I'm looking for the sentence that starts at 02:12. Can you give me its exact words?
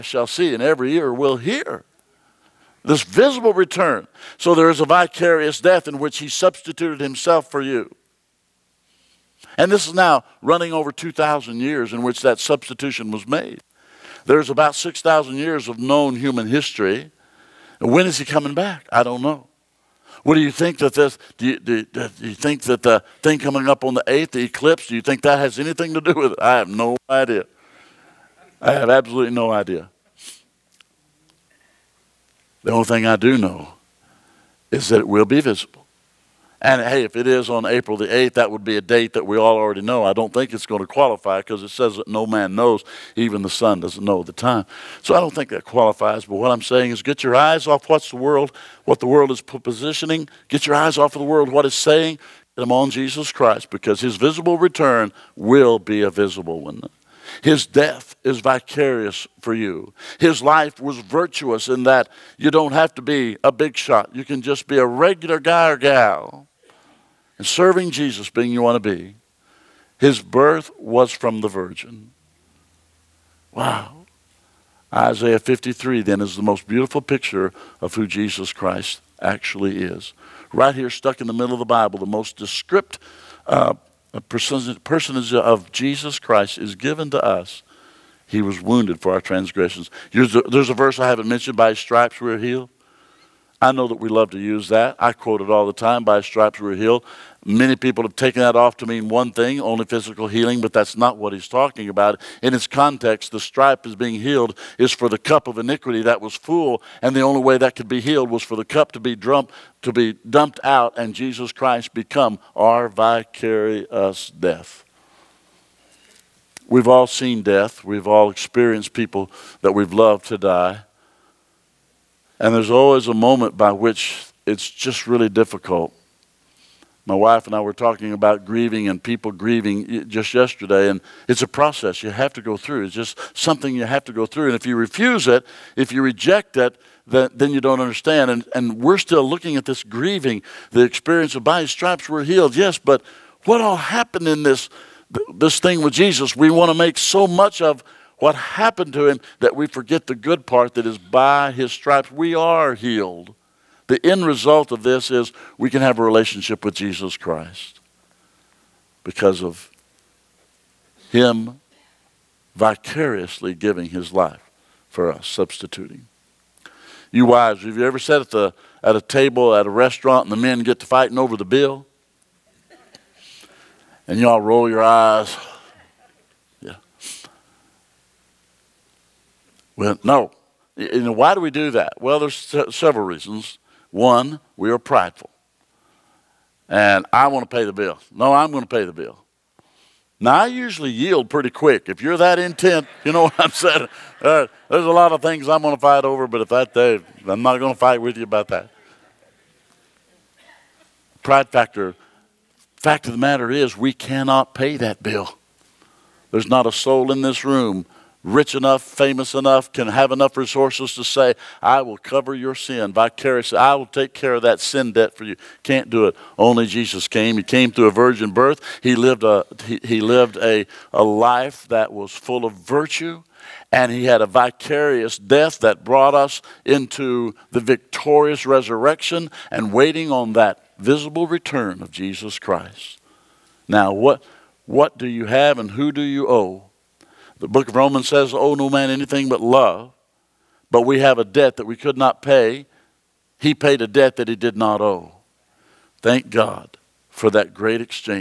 It's just something you have to go through.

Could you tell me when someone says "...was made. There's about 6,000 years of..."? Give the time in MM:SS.
00:13.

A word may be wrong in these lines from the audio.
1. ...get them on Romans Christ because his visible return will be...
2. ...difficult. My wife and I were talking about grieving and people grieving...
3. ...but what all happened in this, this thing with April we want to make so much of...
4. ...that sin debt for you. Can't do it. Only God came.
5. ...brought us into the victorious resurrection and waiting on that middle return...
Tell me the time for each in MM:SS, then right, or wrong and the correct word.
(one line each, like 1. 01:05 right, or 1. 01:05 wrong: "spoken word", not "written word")
1. 00:52 wrong: "Jesus", not "Romans"
2. 02:05 right
3. 02:22 wrong: "Jesus", not "April"
4. 03:34 wrong: "Jesus", not "God"
5. 03:45 wrong: "visible", not "middle".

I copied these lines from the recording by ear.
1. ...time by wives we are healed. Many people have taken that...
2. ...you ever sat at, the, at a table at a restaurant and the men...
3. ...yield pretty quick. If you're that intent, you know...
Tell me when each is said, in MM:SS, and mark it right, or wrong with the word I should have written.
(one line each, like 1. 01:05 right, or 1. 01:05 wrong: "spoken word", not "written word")
1. 01:35 wrong: "stripes", not "wives"
2. 02:47 right
3. 03:10 right.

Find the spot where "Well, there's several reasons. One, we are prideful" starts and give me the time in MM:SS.
03:02.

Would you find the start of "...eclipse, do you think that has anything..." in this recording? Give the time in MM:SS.
00:24.